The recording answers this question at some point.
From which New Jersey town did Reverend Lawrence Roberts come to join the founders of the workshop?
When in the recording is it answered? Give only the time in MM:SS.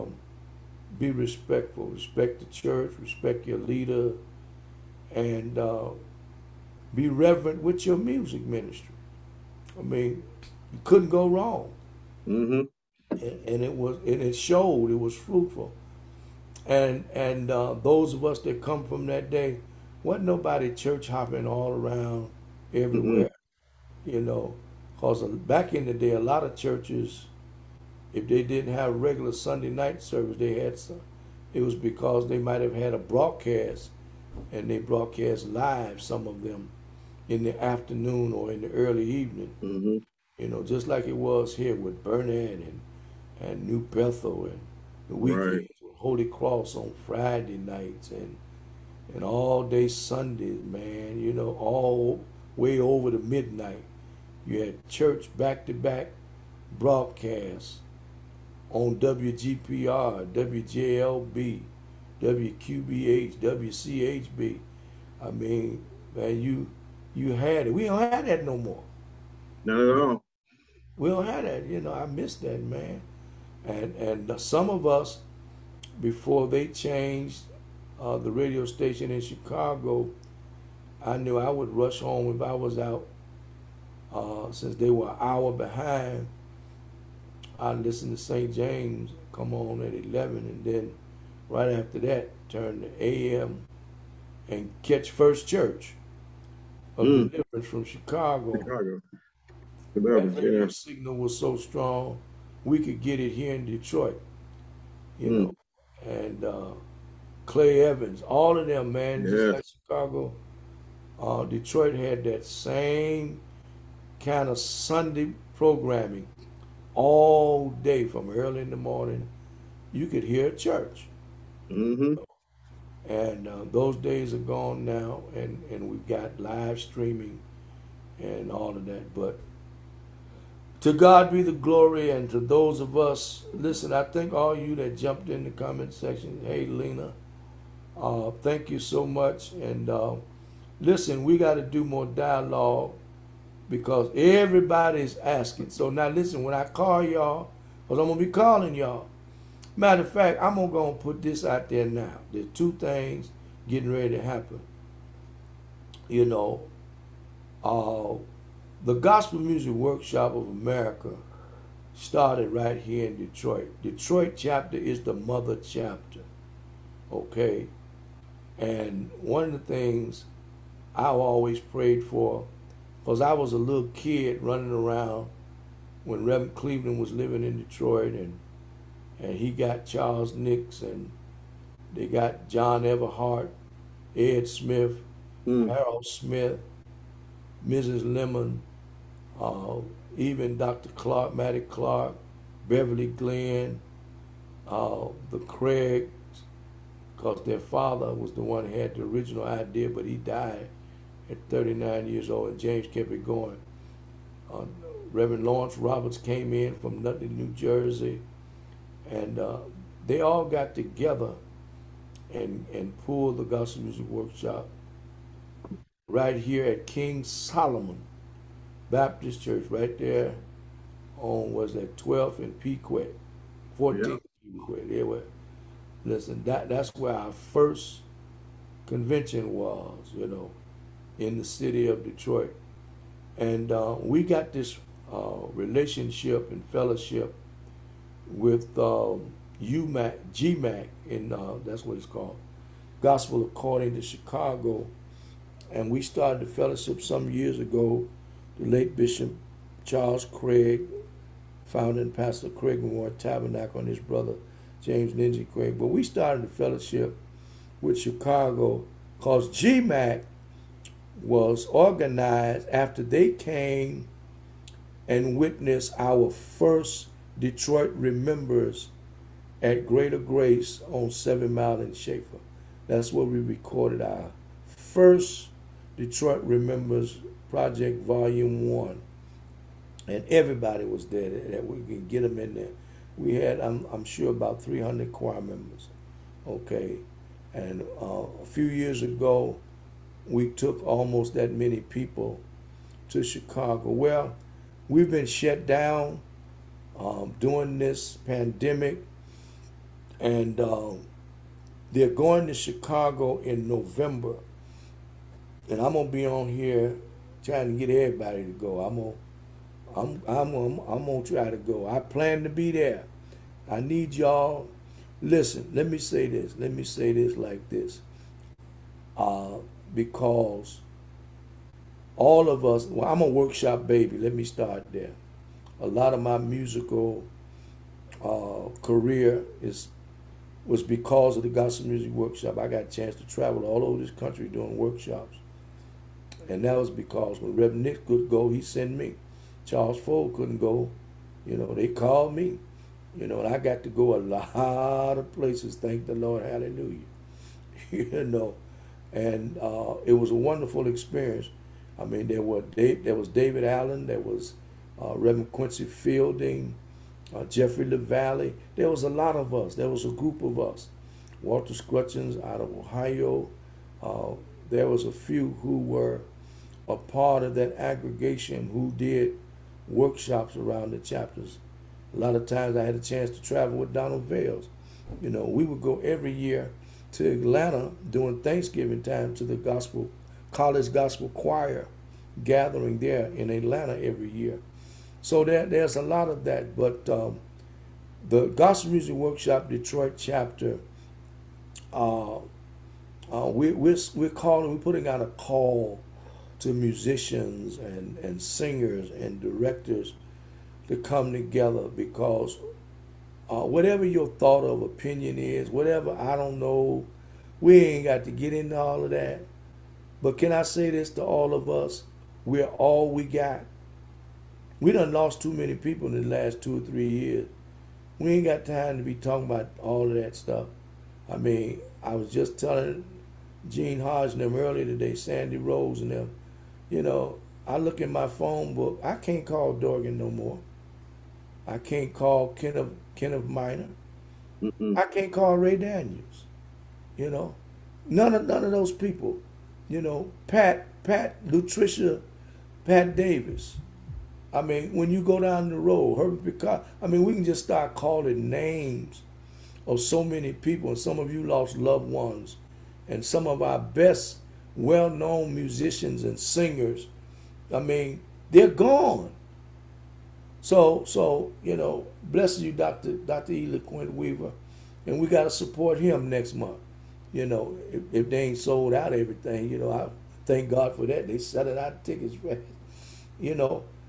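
03:27.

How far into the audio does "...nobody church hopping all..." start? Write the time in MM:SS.
00:20.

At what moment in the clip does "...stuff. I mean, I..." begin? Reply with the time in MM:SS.
07:00.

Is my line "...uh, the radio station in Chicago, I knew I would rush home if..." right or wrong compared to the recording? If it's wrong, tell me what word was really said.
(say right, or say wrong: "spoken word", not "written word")
right.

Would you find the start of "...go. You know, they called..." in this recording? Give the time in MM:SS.
05:40.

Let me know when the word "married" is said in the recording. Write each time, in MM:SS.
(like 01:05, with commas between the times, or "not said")
not said.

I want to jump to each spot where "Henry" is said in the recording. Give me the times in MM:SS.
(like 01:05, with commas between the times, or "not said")
not said.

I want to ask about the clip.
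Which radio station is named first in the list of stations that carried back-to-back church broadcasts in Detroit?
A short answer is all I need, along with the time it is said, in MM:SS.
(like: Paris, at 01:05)
WGPR, at 00:58.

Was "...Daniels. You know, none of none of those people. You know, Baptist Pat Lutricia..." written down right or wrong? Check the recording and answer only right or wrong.
wrong.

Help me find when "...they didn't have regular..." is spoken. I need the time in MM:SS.
00:28.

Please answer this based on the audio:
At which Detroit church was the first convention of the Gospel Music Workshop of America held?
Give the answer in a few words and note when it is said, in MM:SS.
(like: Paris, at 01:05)
King Solomon Baptist Church, at 03:36.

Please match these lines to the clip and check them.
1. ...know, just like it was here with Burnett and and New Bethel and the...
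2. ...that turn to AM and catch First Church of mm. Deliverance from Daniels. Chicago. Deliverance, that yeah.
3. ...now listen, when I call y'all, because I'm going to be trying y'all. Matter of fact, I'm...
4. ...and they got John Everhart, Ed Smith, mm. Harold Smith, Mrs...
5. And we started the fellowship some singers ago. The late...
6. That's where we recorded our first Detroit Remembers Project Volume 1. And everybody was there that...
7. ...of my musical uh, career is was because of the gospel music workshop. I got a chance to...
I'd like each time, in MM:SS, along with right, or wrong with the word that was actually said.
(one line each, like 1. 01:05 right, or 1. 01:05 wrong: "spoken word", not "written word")
1. 00:40 right
2. 01:31 wrong: "Chicago", not "Daniels"
3. 02:25 wrong: "calling", not "trying"
4. 03:00 right
5. 04:05 wrong: "years", not "singers"
6. 04:32 right
7. 05:26 right.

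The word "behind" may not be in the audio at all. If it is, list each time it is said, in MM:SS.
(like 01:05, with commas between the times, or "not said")
01:25.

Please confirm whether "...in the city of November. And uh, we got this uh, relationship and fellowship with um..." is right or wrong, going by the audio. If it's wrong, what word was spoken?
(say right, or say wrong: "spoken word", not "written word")
wrong: "Detroit", not "November".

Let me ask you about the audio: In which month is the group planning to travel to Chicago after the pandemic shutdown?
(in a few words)
November.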